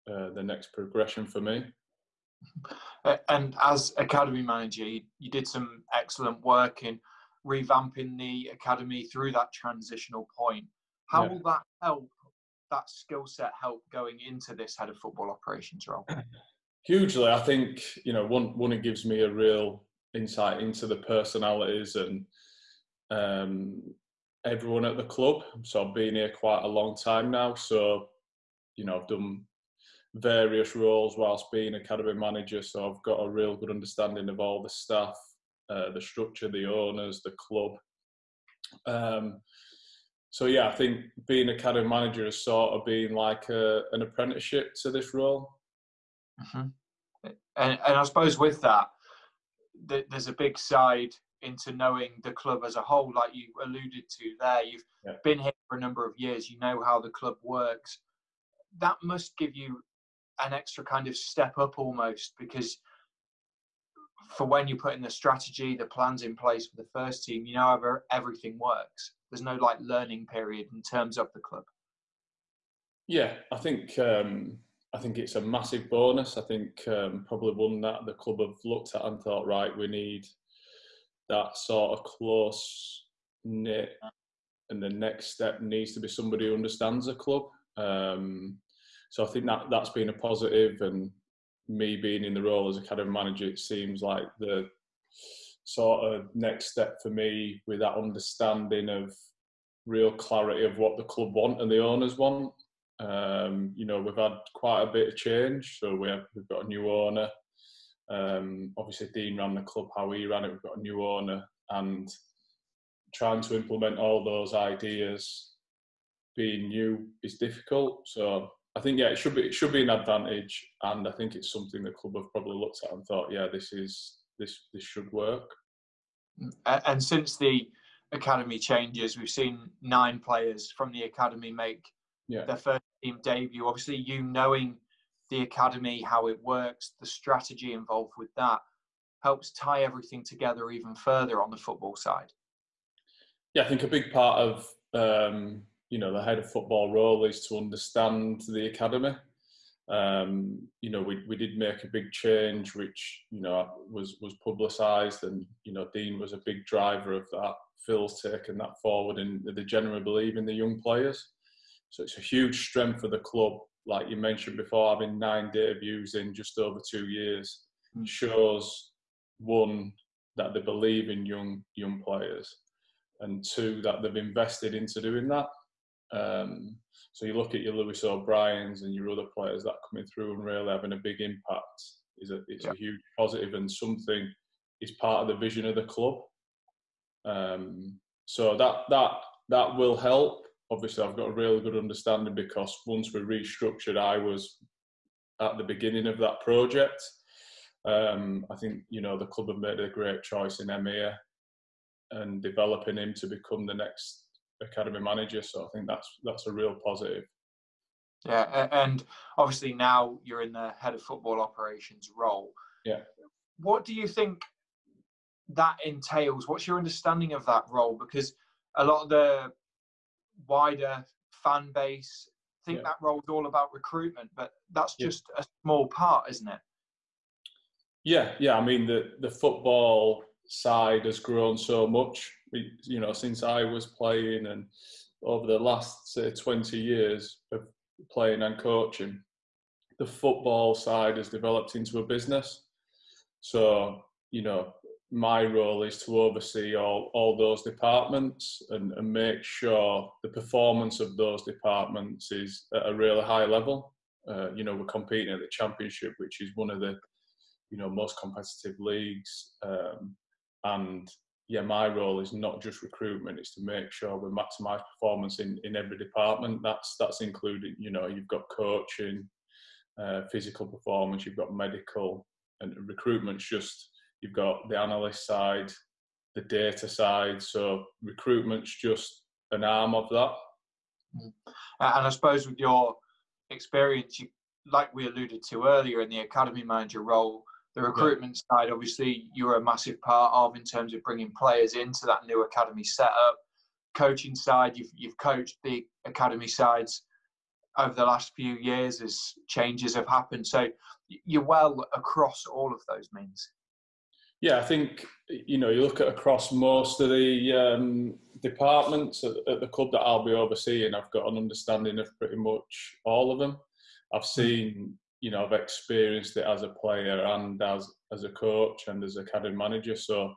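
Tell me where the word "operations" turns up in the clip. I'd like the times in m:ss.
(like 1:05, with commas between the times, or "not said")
0:15, 3:31.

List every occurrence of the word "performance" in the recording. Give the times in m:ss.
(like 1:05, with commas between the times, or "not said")
4:10, 4:24, 4:30.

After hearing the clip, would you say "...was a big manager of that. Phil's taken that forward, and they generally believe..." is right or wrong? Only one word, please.
wrong.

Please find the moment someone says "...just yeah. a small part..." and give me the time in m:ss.
3:44.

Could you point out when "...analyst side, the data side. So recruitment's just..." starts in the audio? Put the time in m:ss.
4:34.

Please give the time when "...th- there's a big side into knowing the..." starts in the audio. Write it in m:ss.
0:49.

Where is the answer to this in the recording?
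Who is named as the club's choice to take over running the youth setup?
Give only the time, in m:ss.
3:20.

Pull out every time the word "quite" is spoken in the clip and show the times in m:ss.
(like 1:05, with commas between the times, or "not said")
0:26, 1:44.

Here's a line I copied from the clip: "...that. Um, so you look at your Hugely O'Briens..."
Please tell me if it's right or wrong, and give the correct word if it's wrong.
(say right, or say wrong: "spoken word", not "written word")
wrong: "Lewis", not "Hugely".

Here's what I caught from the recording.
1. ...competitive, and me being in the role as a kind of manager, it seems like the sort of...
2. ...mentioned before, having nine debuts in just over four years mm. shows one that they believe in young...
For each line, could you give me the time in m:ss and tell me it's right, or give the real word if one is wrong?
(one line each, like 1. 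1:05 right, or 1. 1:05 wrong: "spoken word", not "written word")
1. 1:30 wrong: "positive", not "competitive"
2. 2:44 wrong: "two", not "four".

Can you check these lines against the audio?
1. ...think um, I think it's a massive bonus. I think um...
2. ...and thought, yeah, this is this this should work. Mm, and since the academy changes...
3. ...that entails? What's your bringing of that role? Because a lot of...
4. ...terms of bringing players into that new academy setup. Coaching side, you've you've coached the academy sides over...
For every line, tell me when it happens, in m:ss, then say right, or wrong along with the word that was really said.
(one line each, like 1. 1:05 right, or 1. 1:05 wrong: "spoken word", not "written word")
1. 1:13 right
2. 2:02 right
3. 3:35 wrong: "understanding", not "bringing"
4. 4:50 right.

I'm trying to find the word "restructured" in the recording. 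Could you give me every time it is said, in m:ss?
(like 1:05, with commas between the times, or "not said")
3:13.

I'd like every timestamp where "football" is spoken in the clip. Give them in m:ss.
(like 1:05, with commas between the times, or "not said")
0:14, 2:21, 2:26, 3:31, 3:49, 4:00.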